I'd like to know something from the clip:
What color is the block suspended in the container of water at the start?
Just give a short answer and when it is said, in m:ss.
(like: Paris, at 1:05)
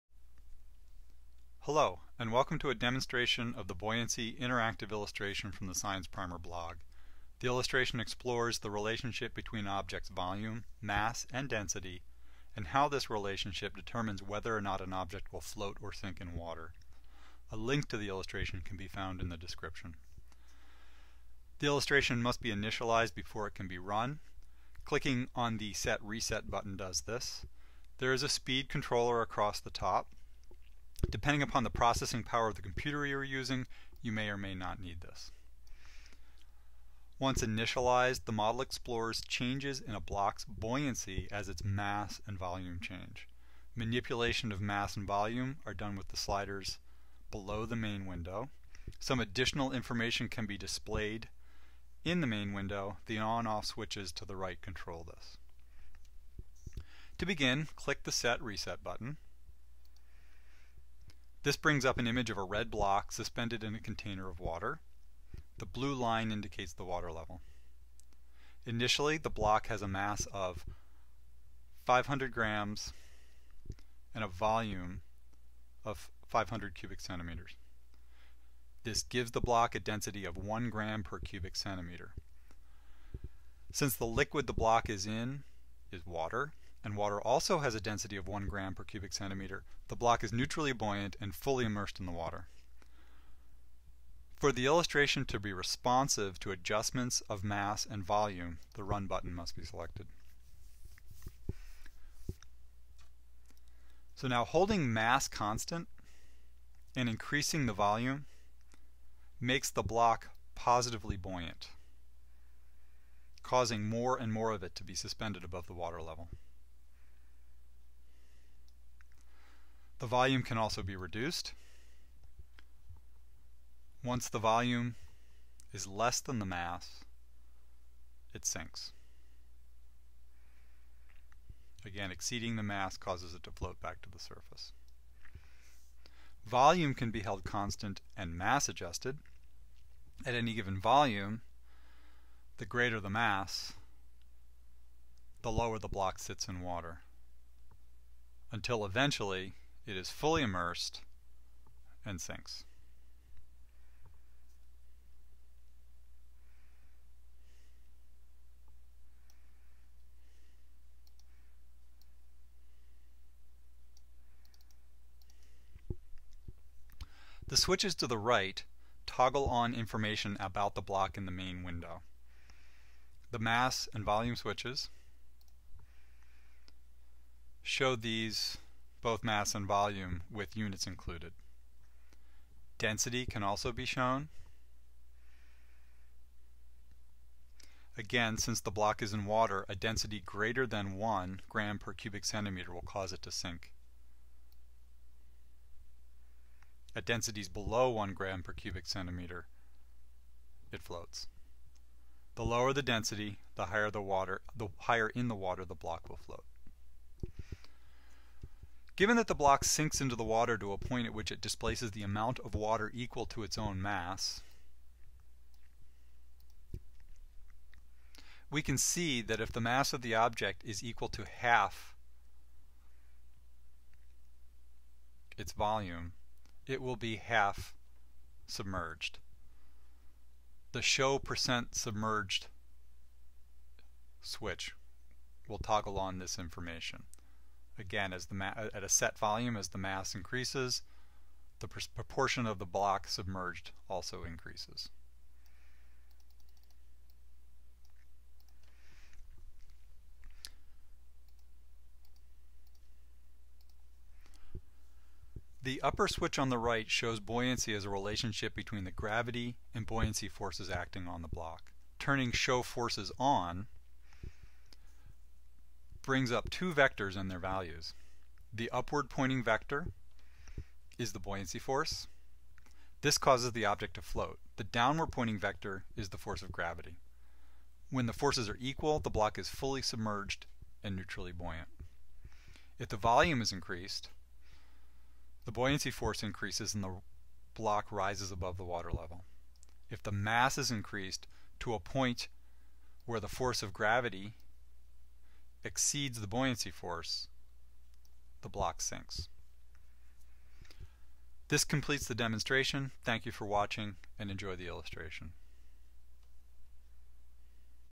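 Red, at 1:02.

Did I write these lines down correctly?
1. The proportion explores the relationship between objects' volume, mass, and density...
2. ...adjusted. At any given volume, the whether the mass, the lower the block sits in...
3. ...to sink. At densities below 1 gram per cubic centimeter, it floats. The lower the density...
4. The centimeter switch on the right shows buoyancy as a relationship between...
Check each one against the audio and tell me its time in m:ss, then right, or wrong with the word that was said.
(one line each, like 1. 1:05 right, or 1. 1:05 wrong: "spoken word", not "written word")
1. 0:07 wrong: "illustration", not "proportion"
2. 2:18 wrong: "greater", not "whether"
3. 3:13 right
4. 4:15 wrong: "upper", not "centimeter".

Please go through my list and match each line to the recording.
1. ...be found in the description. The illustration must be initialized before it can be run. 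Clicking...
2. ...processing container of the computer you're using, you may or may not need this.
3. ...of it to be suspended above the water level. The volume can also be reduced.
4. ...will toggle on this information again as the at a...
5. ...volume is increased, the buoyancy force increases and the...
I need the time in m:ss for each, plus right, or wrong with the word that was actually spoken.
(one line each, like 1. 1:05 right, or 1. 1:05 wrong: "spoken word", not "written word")
1. 0:18 right
2. 0:31 wrong: "power", not "container"
3. 1:54 right
4. 3:55 right
5. 4:42 right.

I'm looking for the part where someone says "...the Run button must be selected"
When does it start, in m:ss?
1:38.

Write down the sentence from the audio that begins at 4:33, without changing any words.
This causes the object to float.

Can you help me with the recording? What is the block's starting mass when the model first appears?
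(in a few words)
500 grams.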